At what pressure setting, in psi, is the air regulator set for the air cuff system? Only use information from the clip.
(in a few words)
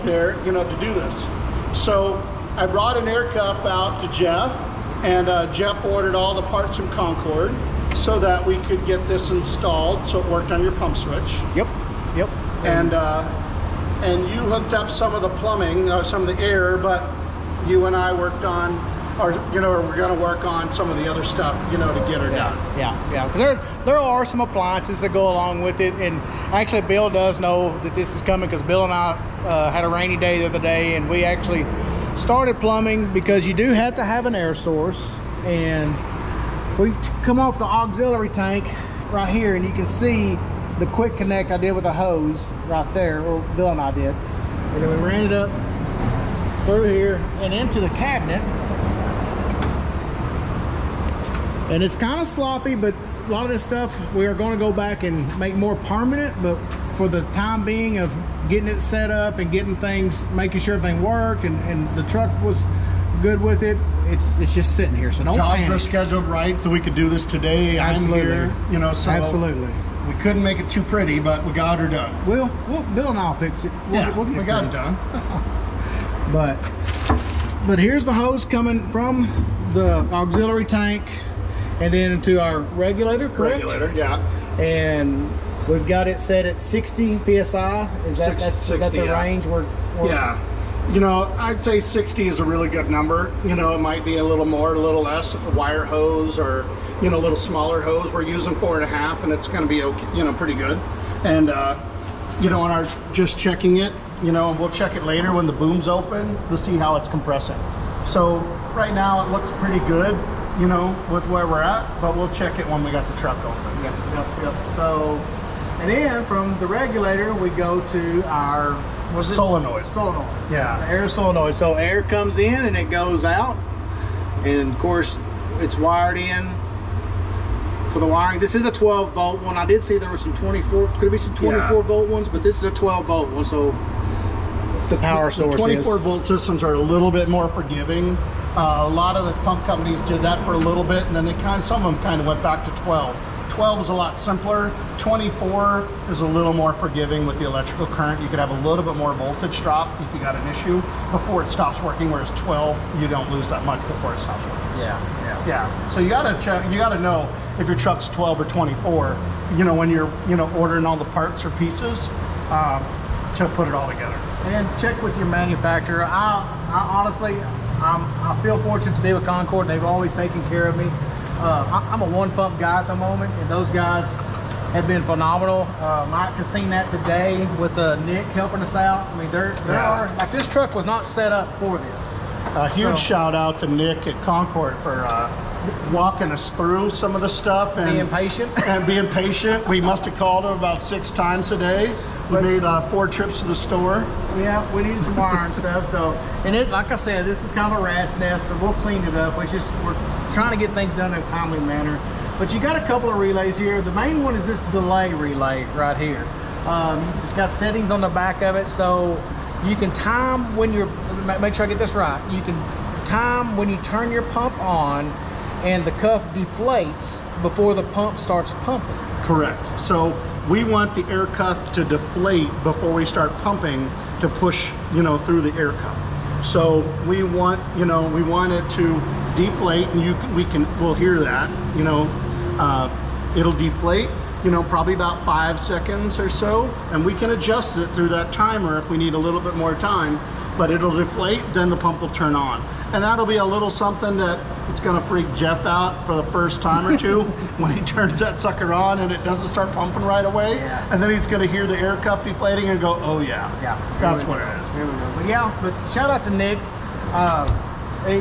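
60 psi.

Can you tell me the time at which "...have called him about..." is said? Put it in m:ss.
3:10.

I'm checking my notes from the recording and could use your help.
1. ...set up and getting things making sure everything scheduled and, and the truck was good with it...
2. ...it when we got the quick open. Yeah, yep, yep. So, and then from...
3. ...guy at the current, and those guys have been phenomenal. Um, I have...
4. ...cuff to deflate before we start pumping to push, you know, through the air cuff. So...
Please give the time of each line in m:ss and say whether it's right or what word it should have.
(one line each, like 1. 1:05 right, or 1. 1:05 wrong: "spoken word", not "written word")
1. 0:58 wrong: "worked", not "scheduled"
2. 1:52 wrong: "truck", not "quick"
3. 2:52 wrong: "moment", not "current"
4. 3:41 right.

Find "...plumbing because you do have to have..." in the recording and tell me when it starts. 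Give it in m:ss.
0:32.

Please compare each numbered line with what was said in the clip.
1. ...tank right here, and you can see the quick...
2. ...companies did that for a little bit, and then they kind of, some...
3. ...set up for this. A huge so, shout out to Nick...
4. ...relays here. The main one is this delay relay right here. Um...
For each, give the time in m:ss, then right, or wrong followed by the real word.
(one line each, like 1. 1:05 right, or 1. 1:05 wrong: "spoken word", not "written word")
1. 0:38 right
2. 2:19 right
3. 3:01 right
4. 3:23 right.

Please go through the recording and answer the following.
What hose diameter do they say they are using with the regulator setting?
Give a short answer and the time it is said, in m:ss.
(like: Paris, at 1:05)
4.5, at 1:38.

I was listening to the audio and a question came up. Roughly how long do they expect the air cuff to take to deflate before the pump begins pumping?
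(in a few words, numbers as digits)
5 seconds.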